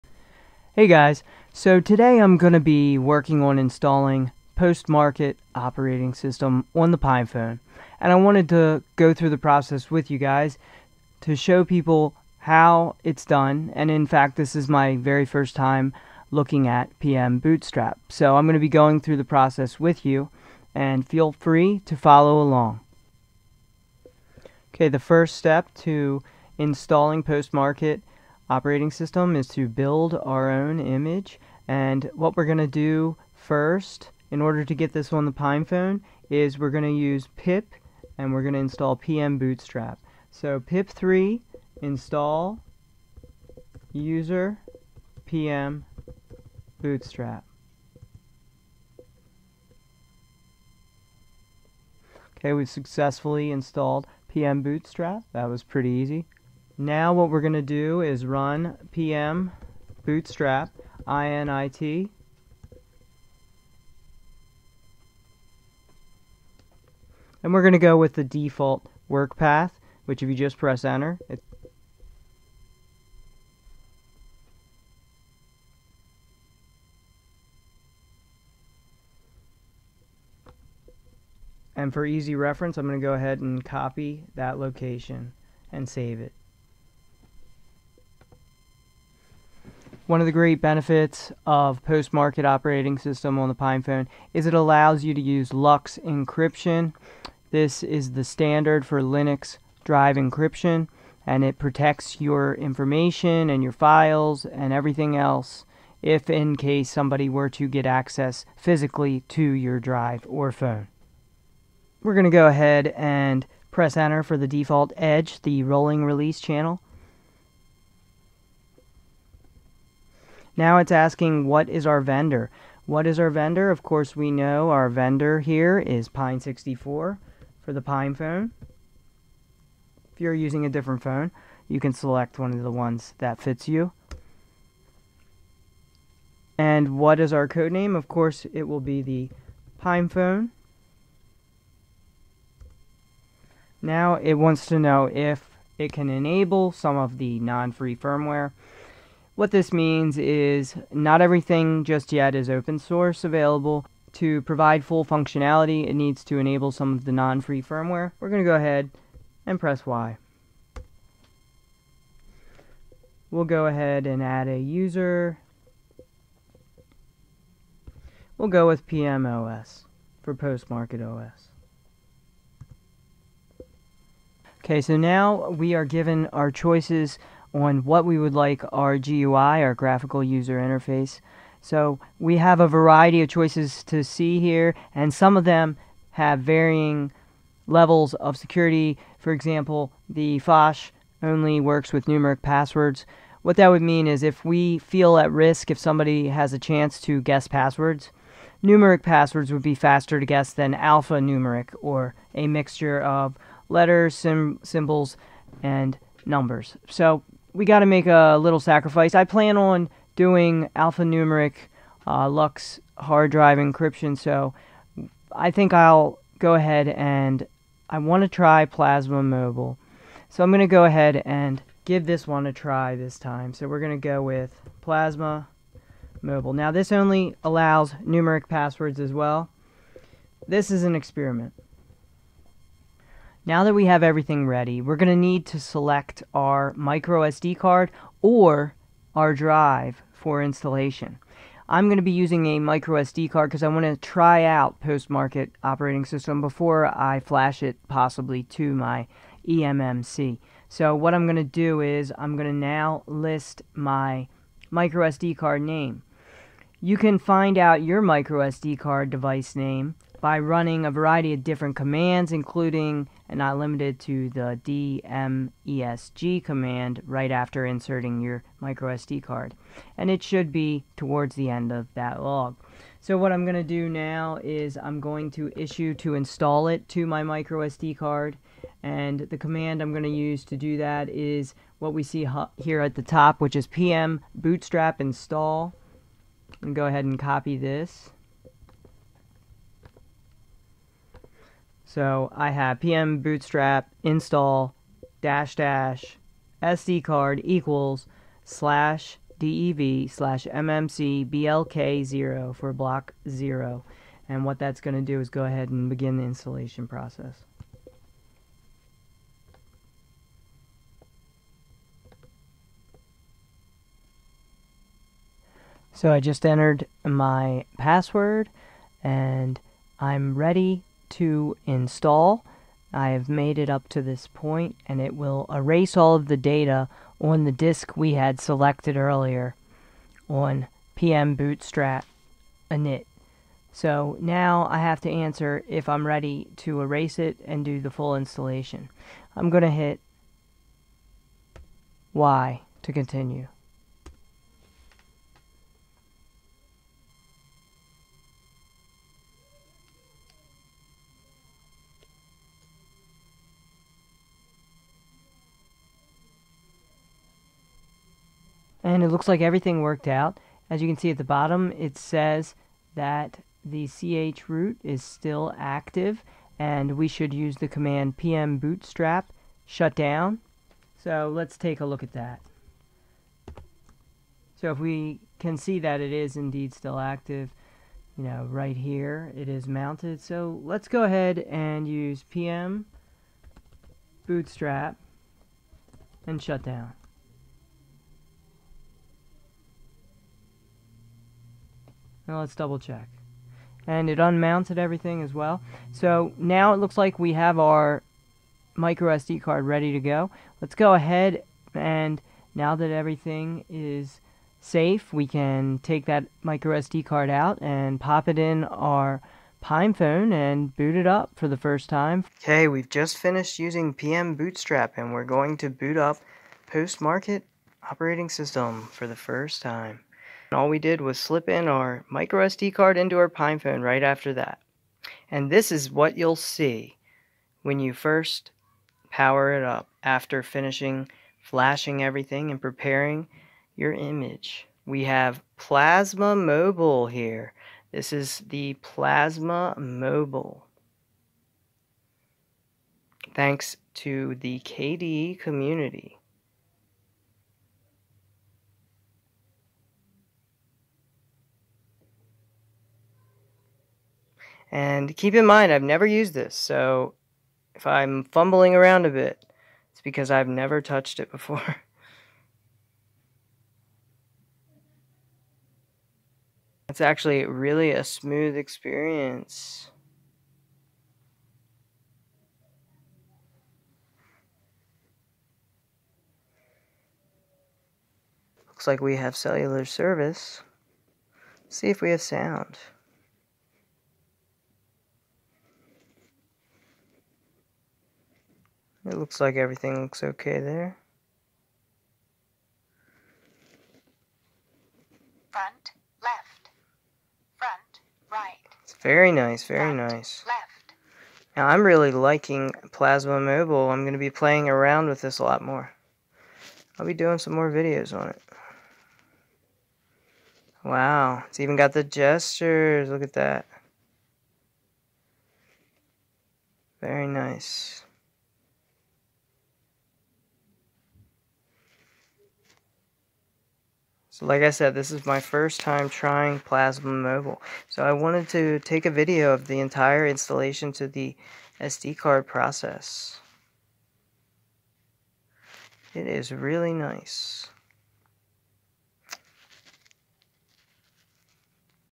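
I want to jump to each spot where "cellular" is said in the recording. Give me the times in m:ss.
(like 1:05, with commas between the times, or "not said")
7:59.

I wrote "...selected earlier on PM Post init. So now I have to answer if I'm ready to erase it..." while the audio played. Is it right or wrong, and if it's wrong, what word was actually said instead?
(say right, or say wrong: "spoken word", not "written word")
wrong: "Bootstrap", not "Post".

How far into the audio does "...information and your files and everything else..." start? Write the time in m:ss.
1:42.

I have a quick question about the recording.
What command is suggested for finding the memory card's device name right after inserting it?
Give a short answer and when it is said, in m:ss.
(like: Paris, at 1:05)
dmesg, at 4:24.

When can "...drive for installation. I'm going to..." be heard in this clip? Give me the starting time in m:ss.
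3:59.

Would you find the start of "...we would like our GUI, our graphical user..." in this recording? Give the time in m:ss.
2:58.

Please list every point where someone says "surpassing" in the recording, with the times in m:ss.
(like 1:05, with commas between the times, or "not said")
not said.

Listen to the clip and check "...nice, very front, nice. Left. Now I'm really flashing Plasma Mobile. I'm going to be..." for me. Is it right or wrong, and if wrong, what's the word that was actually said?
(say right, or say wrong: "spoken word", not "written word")
wrong: "liking", not "flashing".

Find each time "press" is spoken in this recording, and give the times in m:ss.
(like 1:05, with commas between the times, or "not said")
1:10, 1:53, 2:39.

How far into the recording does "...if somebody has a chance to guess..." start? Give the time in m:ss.
3:15.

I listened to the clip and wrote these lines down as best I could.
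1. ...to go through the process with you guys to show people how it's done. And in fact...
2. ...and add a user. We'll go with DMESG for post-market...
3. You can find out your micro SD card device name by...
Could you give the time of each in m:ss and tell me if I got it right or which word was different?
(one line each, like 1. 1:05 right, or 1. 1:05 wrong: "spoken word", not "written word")
1. 0:08 right
2. 2:44 wrong: "PMOS", not "DMESG"
3. 4:16 right.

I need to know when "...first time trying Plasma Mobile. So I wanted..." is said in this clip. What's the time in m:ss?
8:45.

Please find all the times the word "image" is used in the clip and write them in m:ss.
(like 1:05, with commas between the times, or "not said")
0:30, 7:13.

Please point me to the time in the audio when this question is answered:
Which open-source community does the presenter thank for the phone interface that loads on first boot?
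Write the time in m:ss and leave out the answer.
7:24.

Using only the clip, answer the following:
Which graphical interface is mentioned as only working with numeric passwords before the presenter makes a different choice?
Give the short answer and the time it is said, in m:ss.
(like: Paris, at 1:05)
Phosh, at 3:10.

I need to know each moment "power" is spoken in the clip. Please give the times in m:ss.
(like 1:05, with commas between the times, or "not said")
7:09.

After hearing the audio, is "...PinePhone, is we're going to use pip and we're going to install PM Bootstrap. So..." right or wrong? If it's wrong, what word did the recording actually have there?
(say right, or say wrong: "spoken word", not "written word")
right.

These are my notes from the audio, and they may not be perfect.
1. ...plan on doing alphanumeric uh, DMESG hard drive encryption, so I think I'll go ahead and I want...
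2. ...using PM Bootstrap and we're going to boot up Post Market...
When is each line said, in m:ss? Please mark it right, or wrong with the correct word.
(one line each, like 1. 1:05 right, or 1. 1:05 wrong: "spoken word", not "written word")
1. 3:29 wrong: "LUKS", not "DMESG"
2. 6:53 right.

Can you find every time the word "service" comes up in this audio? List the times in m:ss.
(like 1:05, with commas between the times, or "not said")
7:59.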